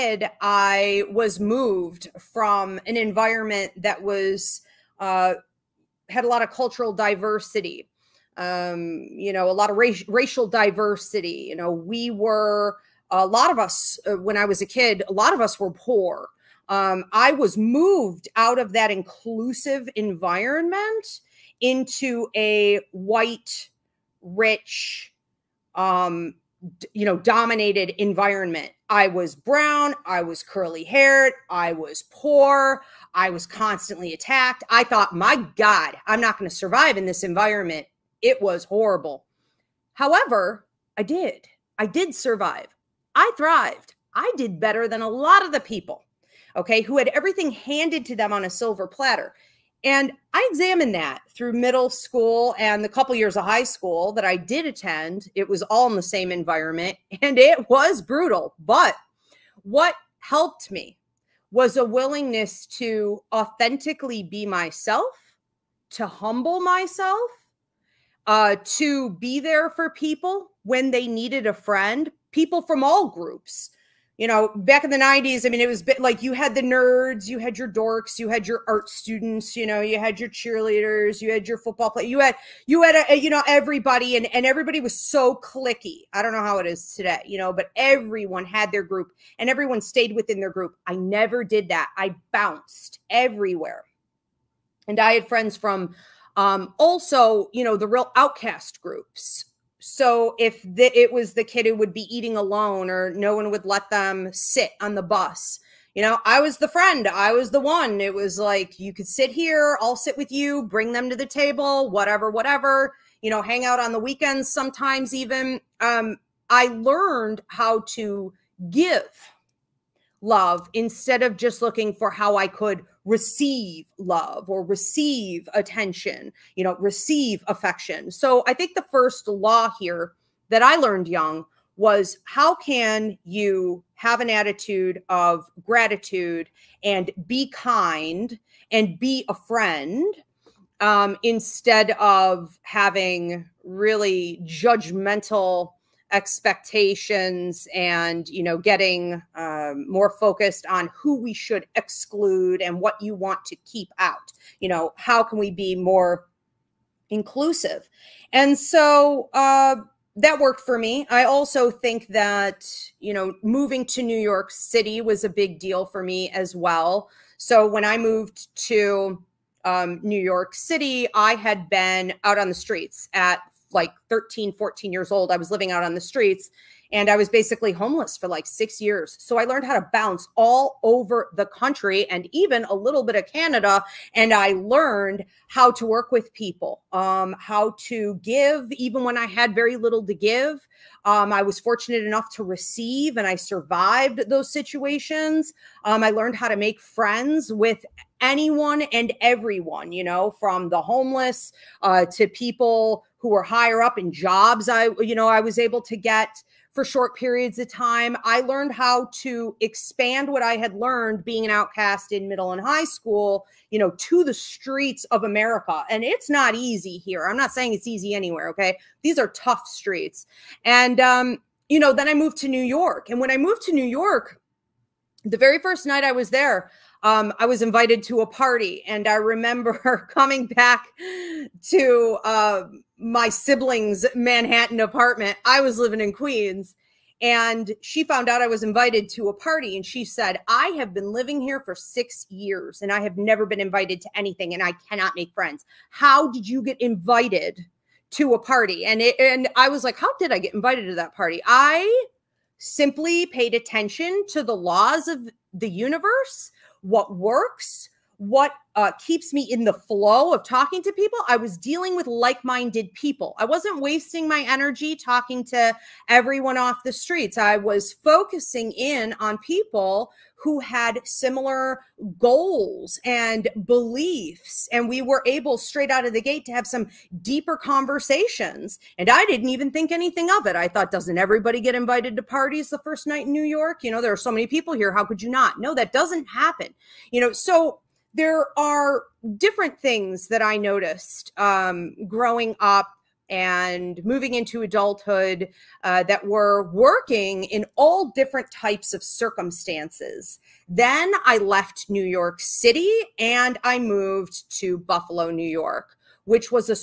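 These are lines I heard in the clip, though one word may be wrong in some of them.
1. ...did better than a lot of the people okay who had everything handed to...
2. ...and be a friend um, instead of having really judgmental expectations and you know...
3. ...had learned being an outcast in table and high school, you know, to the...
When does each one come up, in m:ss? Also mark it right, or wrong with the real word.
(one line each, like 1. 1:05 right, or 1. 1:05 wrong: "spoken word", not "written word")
1. 0:44 right
2. 2:18 right
3. 3:30 wrong: "middle", not "table".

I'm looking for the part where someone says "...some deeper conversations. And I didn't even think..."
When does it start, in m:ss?
4:36.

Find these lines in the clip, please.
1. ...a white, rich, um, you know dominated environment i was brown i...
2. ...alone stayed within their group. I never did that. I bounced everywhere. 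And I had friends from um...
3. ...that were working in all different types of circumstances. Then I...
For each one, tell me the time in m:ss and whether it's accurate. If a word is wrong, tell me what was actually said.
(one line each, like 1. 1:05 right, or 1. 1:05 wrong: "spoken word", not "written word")
1. 0:22 right
2. 1:29 wrong: "everyone", not "alone"
3. 4:56 right.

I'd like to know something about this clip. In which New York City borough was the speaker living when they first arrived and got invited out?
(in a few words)
Queens.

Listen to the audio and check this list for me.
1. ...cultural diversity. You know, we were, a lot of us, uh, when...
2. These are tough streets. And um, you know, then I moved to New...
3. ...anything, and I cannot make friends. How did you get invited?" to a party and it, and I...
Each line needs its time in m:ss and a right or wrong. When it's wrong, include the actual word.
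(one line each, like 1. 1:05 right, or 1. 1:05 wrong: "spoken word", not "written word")
1. 0:10 wrong: "racial", not "cultural"
2. 3:39 right
3. 4:04 right.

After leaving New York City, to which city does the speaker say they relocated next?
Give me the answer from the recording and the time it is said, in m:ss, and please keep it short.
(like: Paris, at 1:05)
Buffalo, New York, at 5:04.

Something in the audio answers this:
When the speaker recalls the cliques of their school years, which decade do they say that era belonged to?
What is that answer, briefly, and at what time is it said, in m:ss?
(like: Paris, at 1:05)
the 90s, at 1:14.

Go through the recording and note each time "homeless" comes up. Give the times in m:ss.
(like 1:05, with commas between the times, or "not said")
2:57, 3:20.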